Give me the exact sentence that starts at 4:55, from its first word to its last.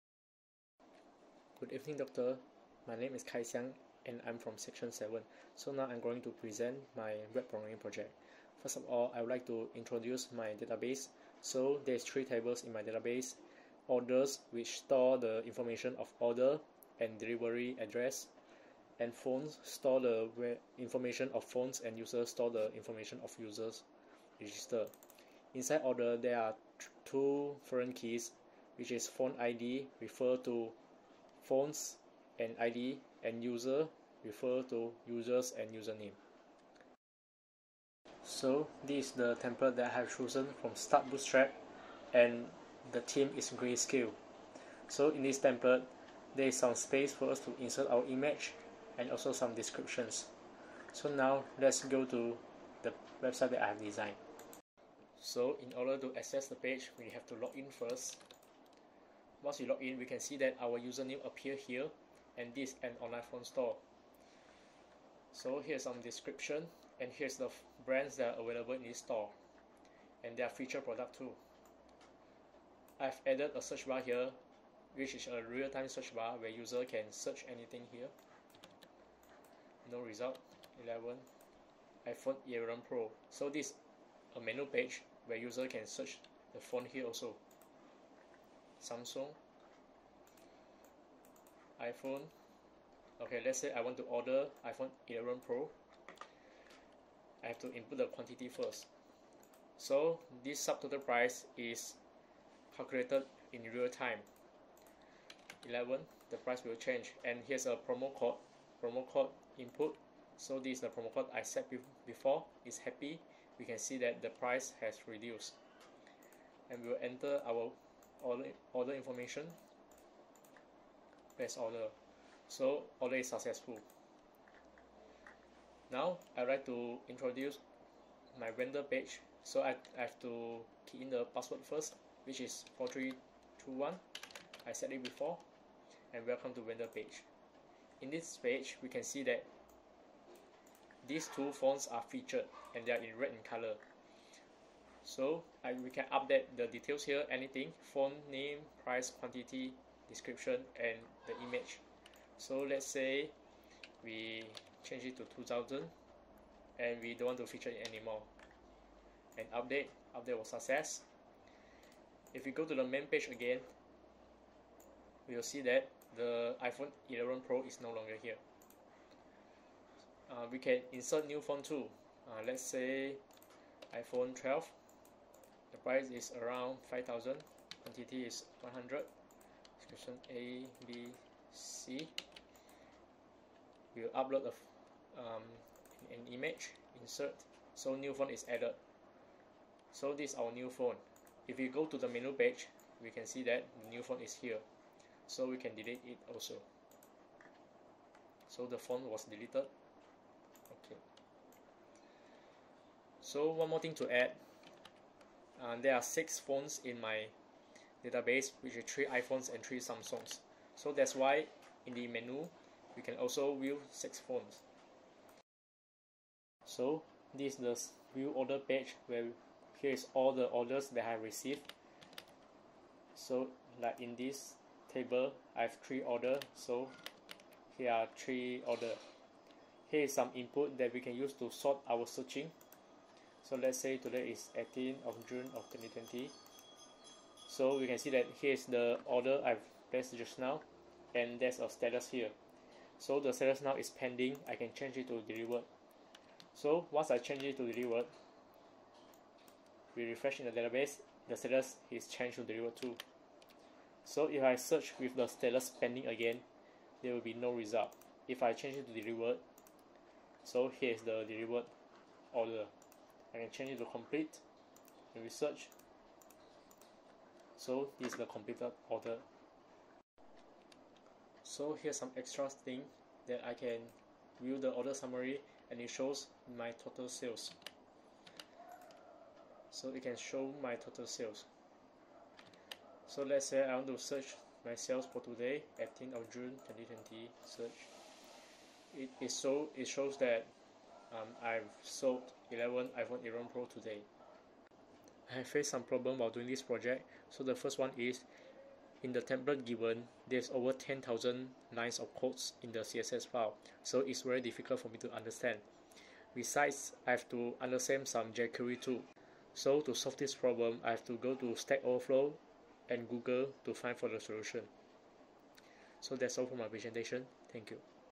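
I have faced some problem while doing this project.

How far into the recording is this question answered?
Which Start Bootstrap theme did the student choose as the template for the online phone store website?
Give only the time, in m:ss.
0:43.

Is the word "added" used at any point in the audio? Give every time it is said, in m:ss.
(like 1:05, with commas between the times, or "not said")
1:13, 3:08.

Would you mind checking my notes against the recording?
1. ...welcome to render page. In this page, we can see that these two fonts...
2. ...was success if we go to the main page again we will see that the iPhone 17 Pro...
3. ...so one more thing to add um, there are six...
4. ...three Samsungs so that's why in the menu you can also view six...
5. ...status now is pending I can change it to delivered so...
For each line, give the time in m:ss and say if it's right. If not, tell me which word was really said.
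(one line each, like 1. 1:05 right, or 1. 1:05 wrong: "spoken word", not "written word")
1. 2:16 right
2. 2:40 wrong: "11", not "17"
3. 3:23 right
4. 3:29 right
5. 4:03 right.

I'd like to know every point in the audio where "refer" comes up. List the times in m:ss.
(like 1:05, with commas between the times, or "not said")
0:30, 0:34.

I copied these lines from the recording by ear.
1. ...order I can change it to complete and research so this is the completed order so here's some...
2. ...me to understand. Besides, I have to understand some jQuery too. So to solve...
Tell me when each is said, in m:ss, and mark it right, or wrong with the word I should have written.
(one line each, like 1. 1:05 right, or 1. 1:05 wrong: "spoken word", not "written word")
1. 4:22 right
2. 5:04 right.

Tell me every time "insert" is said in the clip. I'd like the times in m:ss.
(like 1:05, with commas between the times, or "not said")
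0:47, 2:50, 3:07.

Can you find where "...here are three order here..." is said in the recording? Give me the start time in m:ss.
3:47.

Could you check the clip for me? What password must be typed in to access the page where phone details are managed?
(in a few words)
4321.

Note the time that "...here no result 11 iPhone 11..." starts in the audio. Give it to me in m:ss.
1:17.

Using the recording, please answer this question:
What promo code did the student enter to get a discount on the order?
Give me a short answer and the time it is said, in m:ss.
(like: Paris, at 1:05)
happy, at 1:52.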